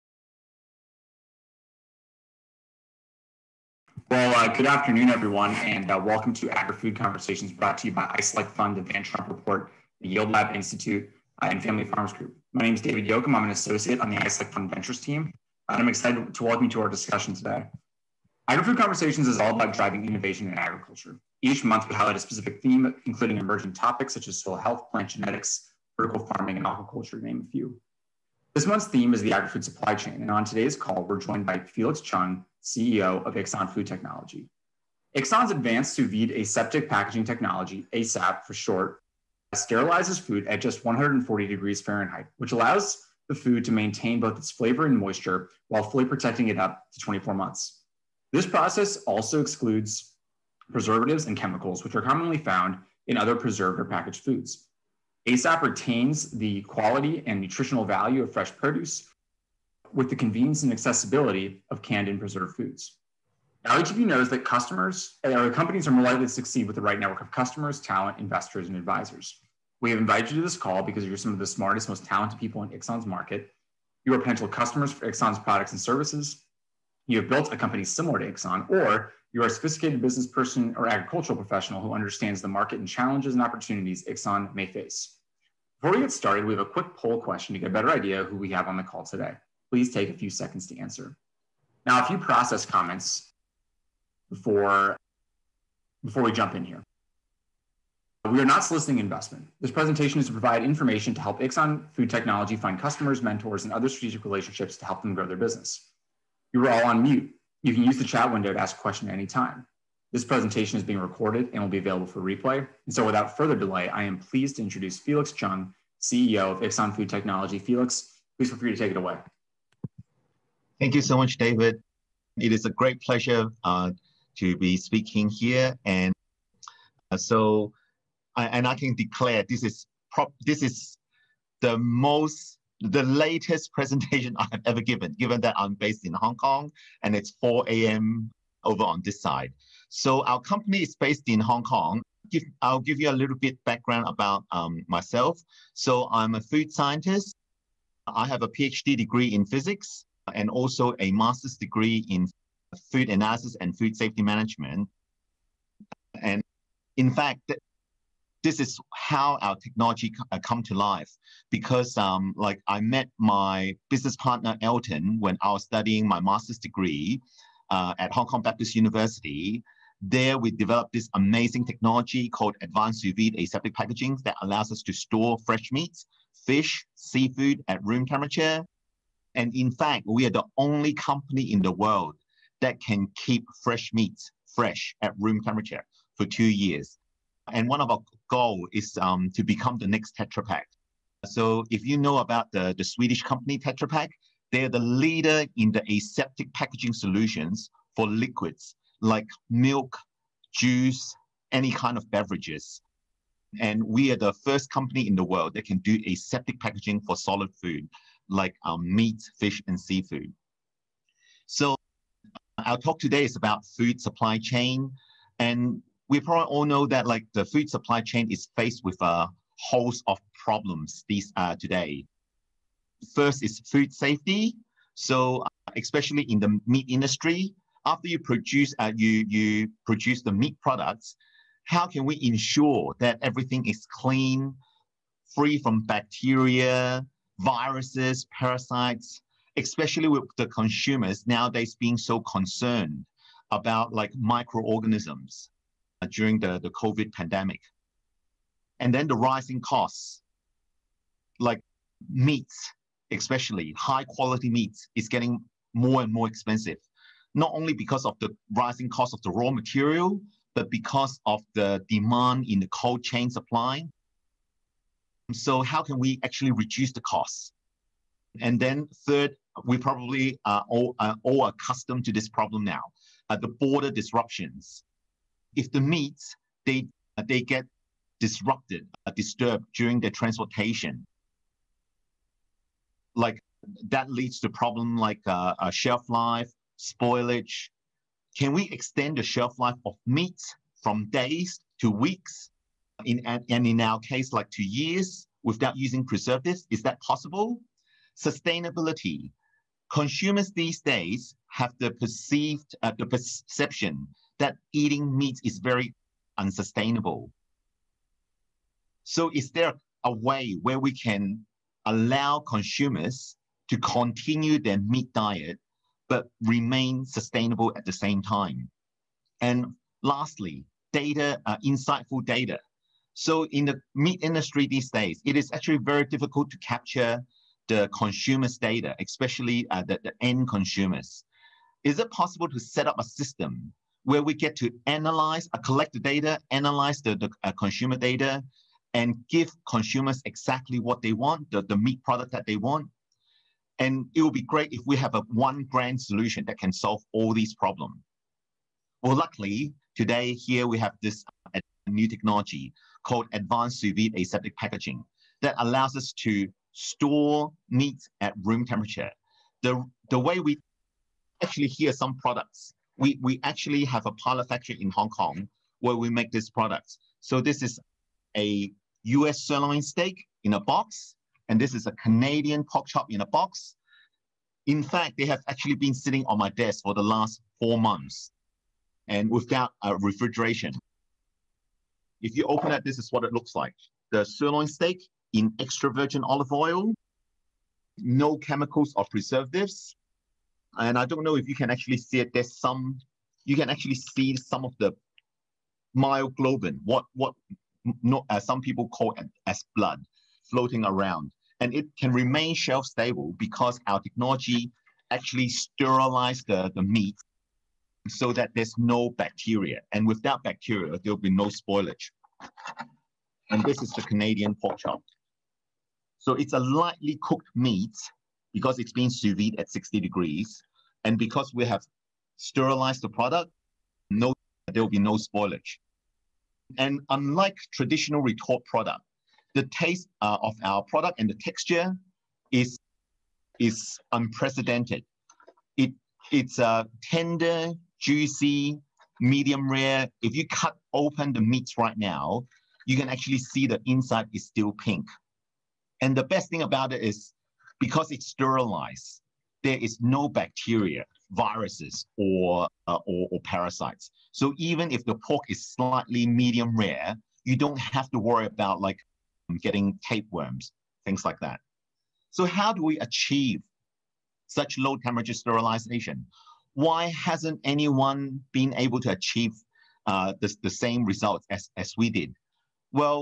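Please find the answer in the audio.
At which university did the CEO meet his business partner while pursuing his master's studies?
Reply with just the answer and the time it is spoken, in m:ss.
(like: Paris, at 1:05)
Hong Kong Baptist University, at 2:48.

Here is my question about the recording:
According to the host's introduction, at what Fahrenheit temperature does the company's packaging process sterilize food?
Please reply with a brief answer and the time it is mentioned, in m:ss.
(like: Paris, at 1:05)
140 degrees Fahrenheit, at 0:40.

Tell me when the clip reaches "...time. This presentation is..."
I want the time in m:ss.
1:49.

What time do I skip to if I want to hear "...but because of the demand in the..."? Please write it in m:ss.
4:20.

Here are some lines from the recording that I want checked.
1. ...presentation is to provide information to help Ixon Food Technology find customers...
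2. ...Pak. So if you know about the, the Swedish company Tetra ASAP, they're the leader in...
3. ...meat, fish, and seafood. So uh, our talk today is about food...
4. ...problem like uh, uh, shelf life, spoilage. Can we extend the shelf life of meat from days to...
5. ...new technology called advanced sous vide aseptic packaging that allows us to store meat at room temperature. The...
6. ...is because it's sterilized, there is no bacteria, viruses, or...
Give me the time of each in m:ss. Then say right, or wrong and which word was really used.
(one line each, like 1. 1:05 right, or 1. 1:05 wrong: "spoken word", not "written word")
1. 1:39 right
2. 3:10 wrong: "Pak", not "ASAP"
3. 3:28 right
4. 4:44 right
5. 5:51 right
6. 7:27 right.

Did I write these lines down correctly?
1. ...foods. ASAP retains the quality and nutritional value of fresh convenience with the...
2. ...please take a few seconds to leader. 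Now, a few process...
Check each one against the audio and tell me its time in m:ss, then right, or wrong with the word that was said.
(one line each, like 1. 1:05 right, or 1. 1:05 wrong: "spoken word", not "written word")
1. 0:54 wrong: "produce", not "convenience"
2. 1:29 wrong: "answer", not "leader".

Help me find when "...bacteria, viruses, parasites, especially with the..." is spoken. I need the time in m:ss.
3:55.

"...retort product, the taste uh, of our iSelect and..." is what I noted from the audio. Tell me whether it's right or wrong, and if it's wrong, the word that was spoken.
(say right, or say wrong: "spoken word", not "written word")
wrong: "product", not "iSelect".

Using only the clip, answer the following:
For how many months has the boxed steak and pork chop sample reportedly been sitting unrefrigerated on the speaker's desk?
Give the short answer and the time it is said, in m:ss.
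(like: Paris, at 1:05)
4 months, at 6:17.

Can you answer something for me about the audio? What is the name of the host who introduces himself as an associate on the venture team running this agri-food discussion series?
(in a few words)
David Yoakum.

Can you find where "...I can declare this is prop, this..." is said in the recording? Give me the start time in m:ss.
2:08.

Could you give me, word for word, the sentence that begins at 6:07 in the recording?
So this is a US sirloin steak in a box, and this is a Canadian pork chop in a box.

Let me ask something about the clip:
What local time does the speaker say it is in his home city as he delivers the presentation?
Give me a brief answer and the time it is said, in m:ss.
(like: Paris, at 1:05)
4 a.m., at 2:17.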